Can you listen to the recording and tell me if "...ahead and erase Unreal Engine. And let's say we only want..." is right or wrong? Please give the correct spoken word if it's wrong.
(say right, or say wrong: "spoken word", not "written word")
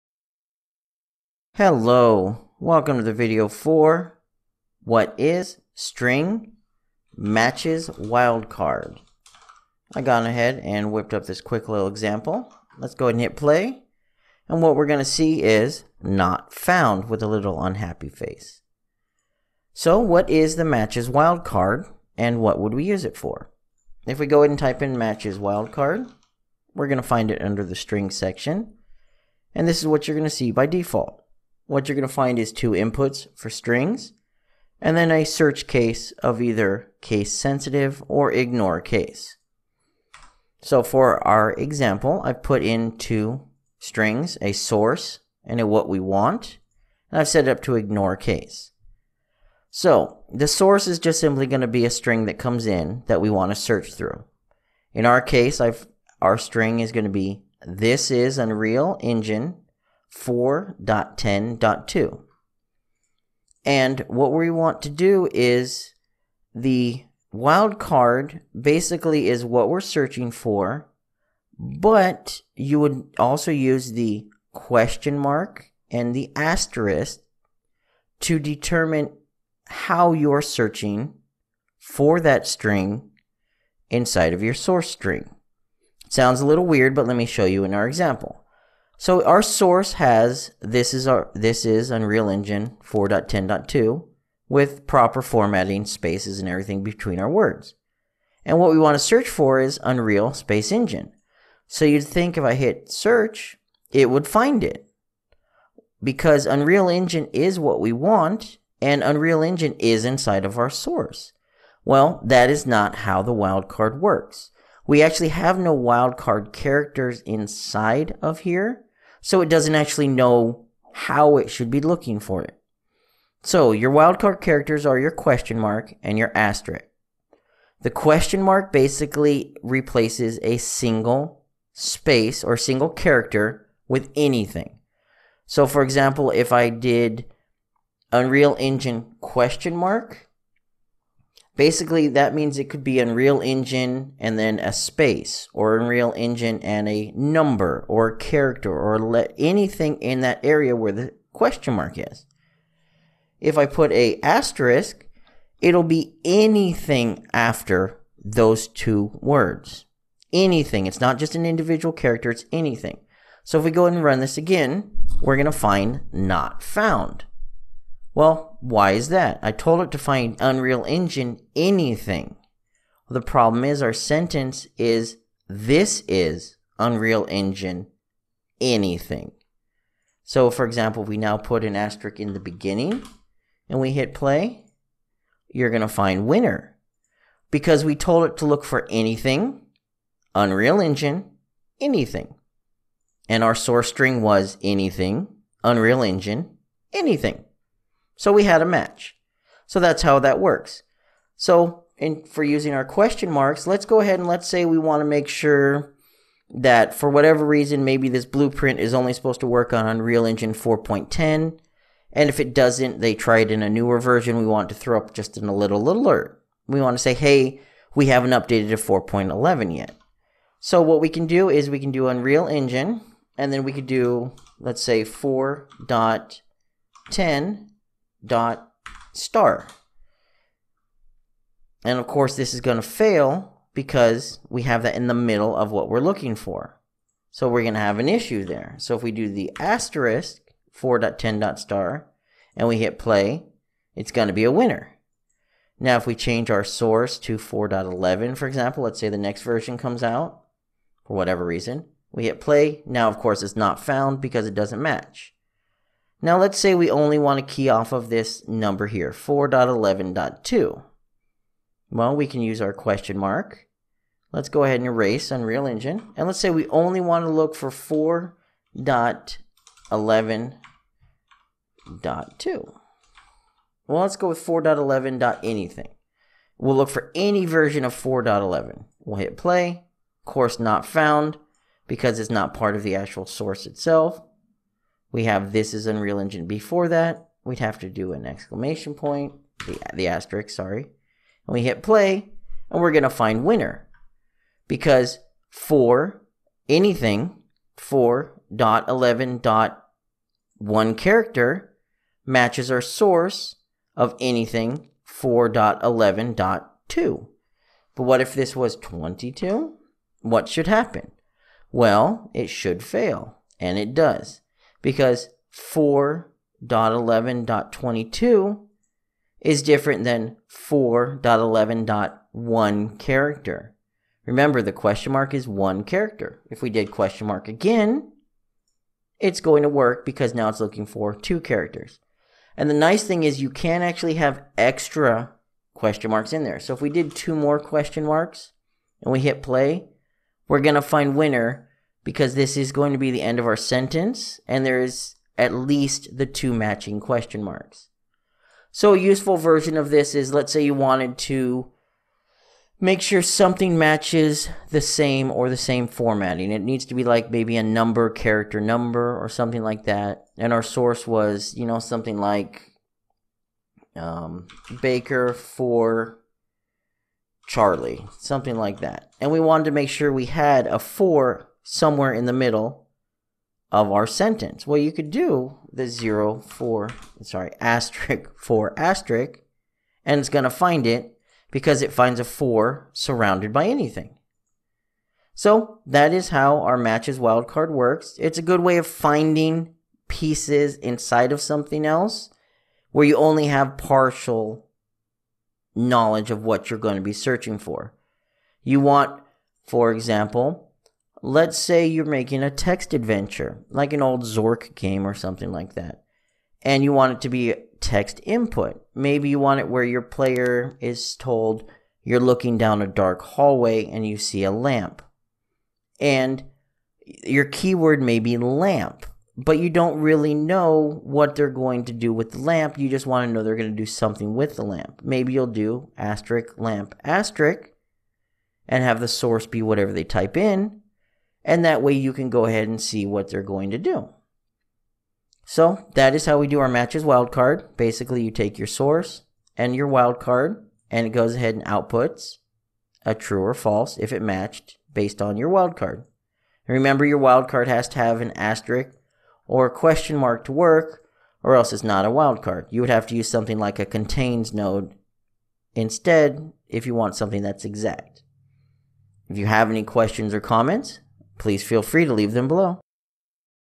right.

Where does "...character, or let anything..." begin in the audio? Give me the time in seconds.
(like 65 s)
148 s.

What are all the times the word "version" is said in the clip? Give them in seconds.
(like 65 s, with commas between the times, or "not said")
213 s, 249 s, 277 s, 349 s.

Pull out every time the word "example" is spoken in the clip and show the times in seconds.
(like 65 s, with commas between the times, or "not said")
11 s, 41 s, 87 s, 135 s, 180 s, 248 s, 399 s.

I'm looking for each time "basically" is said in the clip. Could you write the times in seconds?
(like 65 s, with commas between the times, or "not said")
68 s, 128 s, 141 s, 437 s.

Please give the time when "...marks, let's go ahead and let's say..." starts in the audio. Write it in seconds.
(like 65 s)
203 s.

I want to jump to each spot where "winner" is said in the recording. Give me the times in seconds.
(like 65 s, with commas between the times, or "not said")
186 s, 244 s, 293 s, 341 s.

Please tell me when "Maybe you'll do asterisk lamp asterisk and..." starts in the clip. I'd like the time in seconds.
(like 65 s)
425 s.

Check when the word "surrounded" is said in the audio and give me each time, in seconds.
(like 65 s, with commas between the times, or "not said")
382 s.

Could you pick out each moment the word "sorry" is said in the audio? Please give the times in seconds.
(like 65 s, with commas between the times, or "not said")
290 s, 377 s.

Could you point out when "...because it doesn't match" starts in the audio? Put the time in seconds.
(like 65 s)
254 s.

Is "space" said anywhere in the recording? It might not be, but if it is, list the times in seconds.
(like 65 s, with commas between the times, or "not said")
95 s, 100 s, 131 s, 144 s.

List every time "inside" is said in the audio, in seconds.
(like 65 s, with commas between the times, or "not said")
83 s, 110 s, 117 s, 390 s.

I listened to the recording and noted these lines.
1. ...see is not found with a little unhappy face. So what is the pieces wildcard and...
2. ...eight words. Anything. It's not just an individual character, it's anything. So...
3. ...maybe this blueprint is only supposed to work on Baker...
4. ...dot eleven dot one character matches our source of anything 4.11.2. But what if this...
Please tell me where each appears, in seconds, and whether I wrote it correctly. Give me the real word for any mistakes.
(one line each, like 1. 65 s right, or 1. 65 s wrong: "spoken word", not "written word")
1. 15 s wrong: "matches", not "pieces"
2. 158 s wrong: "two", not "eight"
3. 207 s wrong: "Unreal", not "Baker"
4. 298 s right.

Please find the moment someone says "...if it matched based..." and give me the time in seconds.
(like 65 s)
443 s.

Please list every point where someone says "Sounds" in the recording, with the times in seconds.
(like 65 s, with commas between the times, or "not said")
86 s.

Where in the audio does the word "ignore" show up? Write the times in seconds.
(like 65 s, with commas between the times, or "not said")
38 s, 47 s.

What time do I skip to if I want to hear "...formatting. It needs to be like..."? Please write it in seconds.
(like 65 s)
355 s.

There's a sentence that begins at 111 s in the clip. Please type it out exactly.
Well, that is not how the wildcard works.